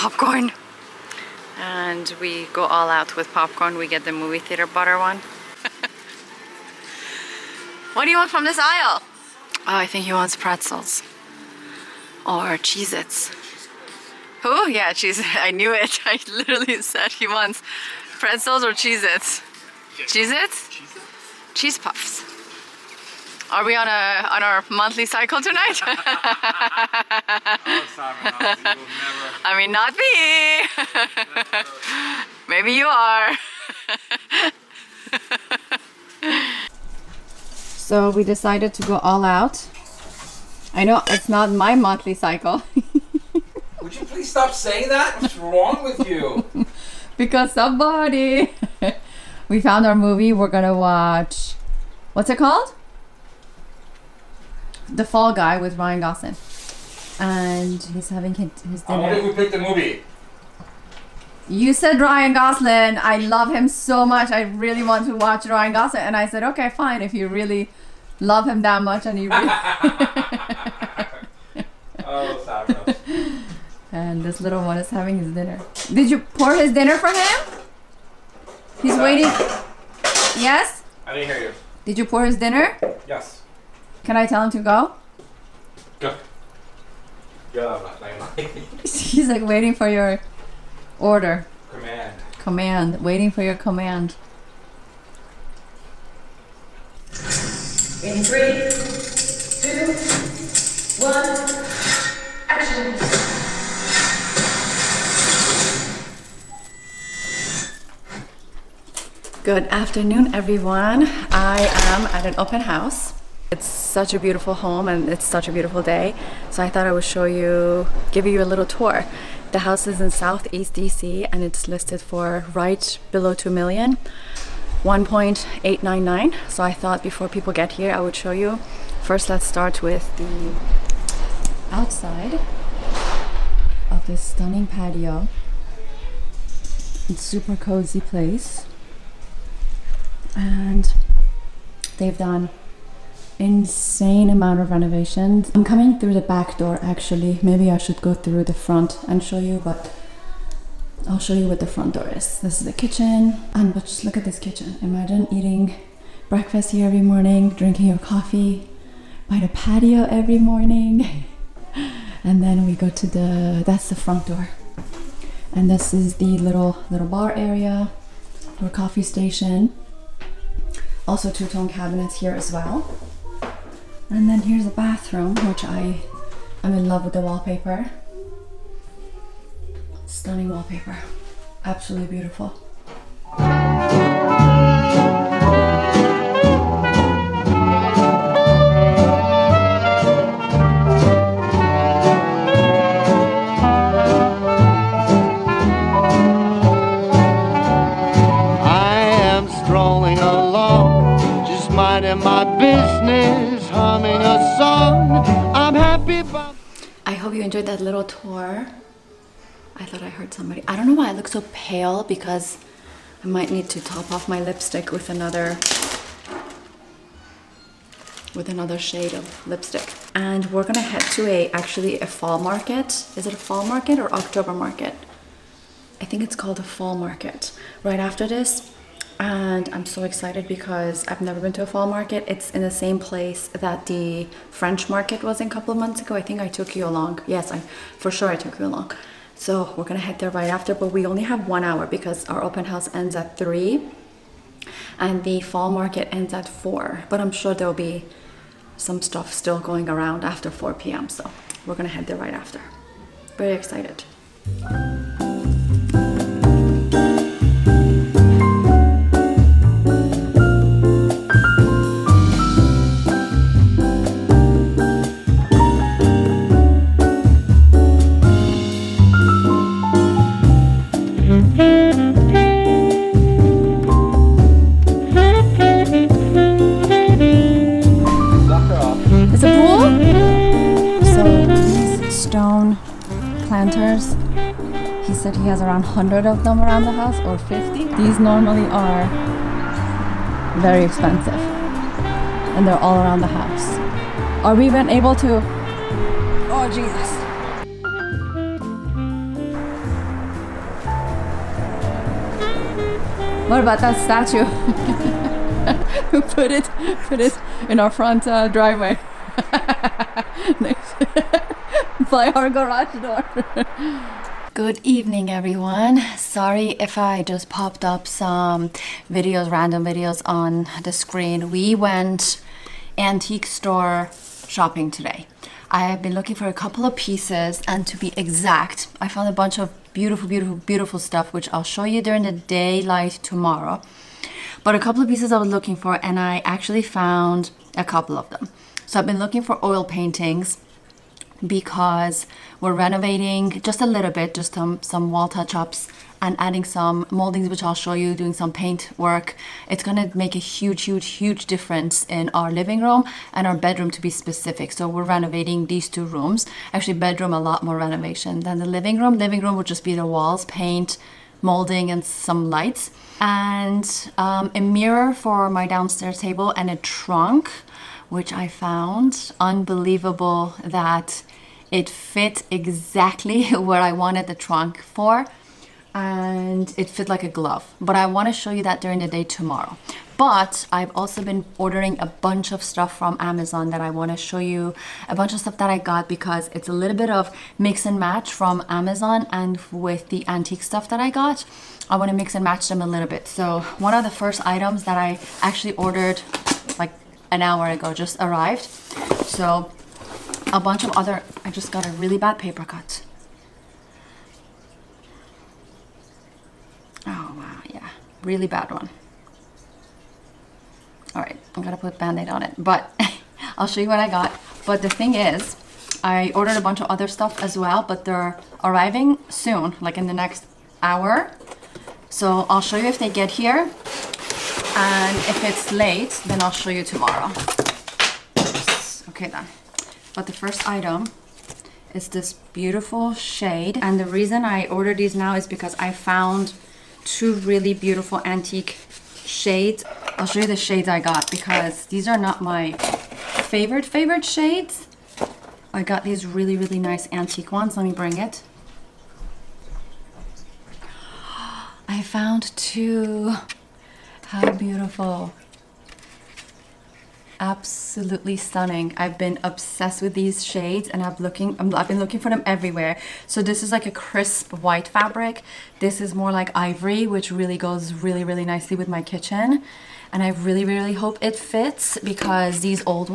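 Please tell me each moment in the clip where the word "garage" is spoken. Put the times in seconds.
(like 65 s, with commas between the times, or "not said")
312 s.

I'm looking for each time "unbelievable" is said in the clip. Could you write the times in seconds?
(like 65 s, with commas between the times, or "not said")
369 s.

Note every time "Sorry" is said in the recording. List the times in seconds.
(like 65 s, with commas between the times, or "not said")
316 s.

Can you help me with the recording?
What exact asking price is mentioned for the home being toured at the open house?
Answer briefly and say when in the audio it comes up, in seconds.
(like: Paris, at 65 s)
1.899 million, at 124 s.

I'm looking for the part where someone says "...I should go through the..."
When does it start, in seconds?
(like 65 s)
147 s.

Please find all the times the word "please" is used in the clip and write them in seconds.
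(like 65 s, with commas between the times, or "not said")
44 s.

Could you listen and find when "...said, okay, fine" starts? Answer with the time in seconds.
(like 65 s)
66 s.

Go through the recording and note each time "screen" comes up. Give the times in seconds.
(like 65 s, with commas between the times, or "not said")
320 s.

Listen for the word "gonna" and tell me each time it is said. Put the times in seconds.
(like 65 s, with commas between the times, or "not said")
50 s, 220 s, 239 s, 251 s, 349 s, 411 s.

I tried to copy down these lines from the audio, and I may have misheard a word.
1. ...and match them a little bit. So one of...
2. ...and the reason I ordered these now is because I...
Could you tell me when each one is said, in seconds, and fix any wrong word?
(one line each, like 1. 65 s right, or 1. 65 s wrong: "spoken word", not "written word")
1. 392 s right
2. 433 s right.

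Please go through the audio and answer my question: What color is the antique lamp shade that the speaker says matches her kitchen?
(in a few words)
Ivory.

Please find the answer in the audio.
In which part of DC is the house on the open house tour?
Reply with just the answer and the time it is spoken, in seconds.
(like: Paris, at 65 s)
Southeast DC, at 120 s.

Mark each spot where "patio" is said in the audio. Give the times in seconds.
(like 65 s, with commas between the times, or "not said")
134 s, 159 s.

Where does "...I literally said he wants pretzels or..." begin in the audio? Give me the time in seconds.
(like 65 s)
16 s.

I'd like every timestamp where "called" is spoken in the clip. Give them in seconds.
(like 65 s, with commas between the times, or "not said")
52 s, 226 s.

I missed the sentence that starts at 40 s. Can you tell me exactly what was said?
I know it's not my monthly cycle.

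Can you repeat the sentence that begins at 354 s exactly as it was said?
So we're renovating these two rooms.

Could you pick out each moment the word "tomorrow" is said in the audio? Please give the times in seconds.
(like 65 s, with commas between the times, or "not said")
333 s, 379 s, 426 s.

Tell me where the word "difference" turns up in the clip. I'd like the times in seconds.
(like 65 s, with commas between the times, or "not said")
351 s.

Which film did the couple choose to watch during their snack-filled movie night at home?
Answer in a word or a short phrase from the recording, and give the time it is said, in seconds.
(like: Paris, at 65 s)
The Fall Guy, at 54 s.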